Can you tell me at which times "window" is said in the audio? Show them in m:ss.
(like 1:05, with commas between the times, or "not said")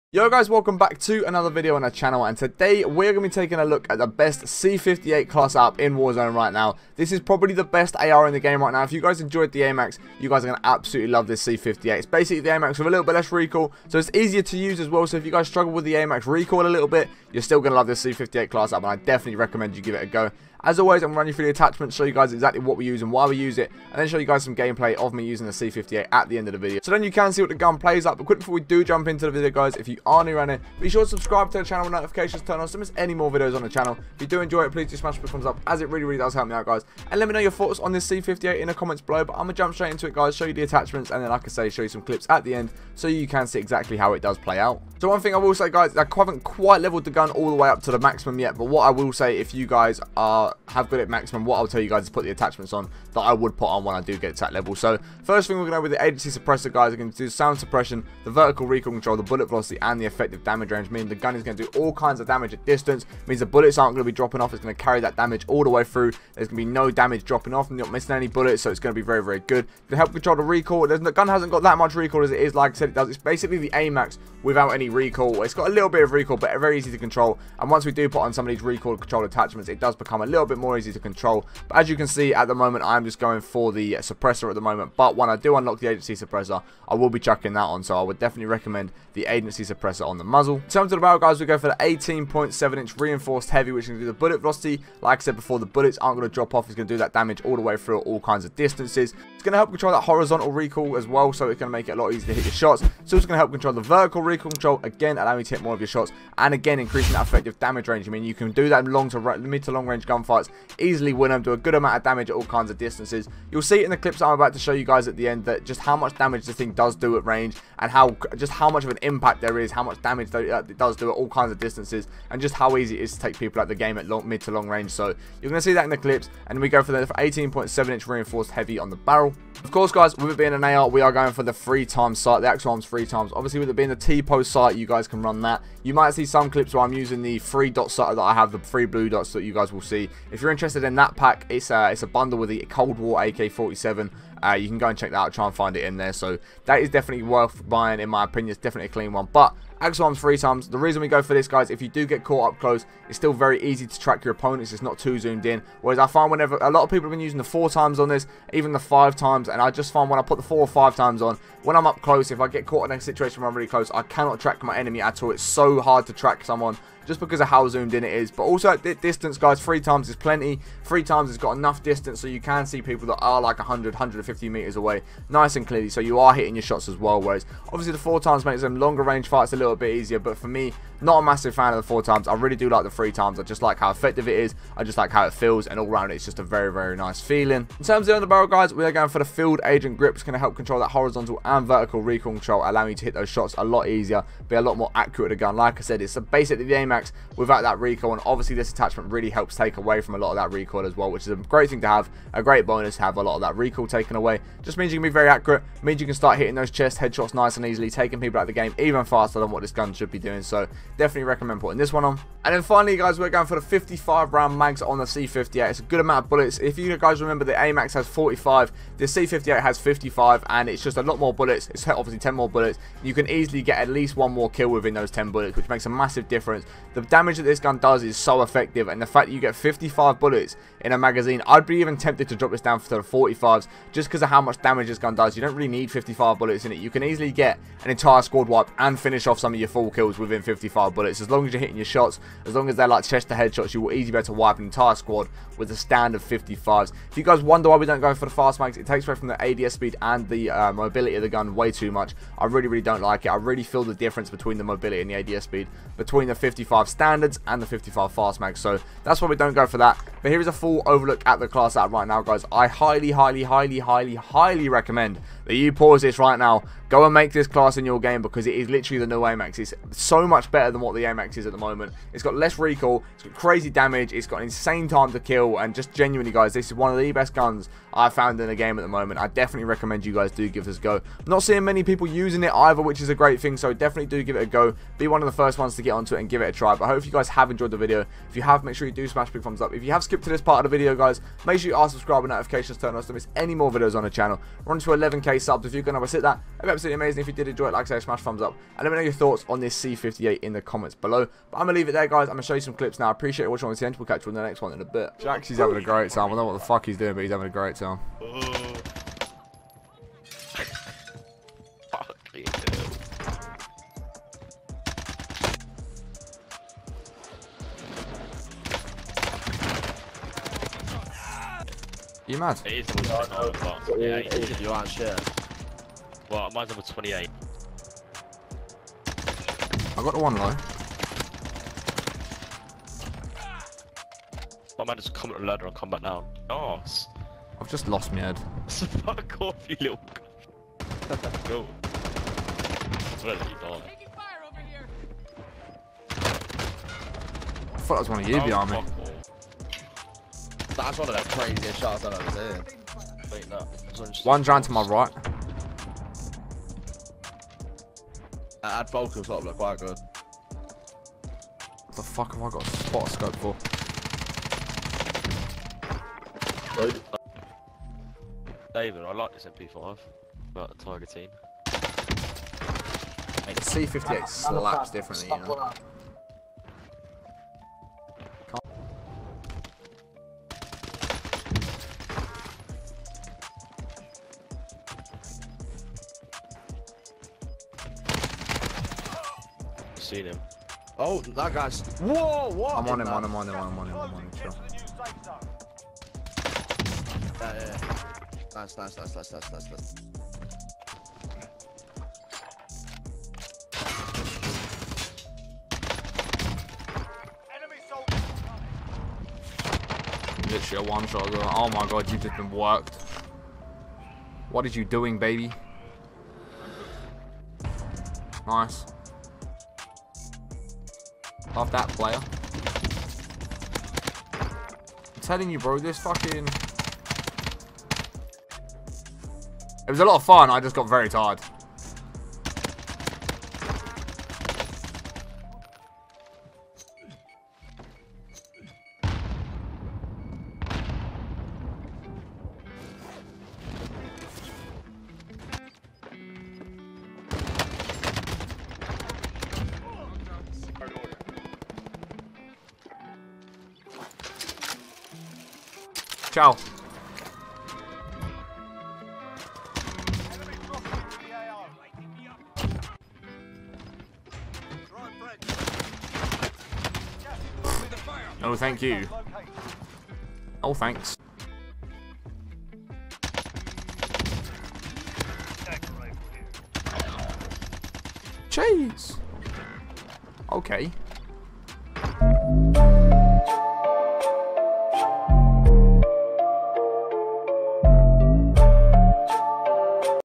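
not said.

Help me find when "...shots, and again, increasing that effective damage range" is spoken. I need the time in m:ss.
1:45.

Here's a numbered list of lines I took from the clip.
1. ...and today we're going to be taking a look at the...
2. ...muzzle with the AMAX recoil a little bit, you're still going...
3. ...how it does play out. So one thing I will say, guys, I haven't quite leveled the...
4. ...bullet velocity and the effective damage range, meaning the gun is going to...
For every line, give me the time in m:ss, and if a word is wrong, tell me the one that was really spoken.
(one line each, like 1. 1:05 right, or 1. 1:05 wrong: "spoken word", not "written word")
1. 0:02 right
2. 0:15 wrong: "struggle", not "muzzle"
3. 0:43 right
4. 0:59 right.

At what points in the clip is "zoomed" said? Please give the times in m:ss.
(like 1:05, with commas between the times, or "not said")
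2:35, 2:47.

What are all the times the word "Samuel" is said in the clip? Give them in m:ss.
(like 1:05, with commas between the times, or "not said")
not said.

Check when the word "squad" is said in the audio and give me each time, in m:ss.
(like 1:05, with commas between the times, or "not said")
3:58, 4:04.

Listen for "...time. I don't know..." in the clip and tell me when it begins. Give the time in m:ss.
5:06.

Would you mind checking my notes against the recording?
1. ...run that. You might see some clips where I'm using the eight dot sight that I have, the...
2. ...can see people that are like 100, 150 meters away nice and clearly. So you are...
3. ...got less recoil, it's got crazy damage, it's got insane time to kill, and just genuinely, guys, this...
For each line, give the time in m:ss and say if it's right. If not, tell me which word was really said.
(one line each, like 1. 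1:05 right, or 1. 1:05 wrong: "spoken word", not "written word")
1. 2:15 wrong: "three", not "eight"
2. 2:52 right
3. 4:32 right.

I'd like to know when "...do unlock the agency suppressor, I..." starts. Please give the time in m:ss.
1:25.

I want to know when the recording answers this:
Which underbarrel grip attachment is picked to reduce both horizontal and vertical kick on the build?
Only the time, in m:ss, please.
3:09.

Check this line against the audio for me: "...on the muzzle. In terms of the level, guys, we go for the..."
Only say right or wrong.
wrong.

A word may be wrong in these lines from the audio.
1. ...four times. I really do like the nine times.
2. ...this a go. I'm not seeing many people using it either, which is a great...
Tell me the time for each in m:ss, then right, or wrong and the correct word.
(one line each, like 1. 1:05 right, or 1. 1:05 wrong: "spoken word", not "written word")
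1. 3:01 wrong: "three", not "nine"
2. 4:40 right.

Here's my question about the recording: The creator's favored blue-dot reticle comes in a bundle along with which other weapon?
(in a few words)
Cold War AK-47.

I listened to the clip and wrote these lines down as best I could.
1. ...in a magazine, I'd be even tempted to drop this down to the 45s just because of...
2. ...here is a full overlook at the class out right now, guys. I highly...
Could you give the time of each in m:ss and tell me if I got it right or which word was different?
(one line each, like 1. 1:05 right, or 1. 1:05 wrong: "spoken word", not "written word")
1. 3:50 right
2. 4:20 right.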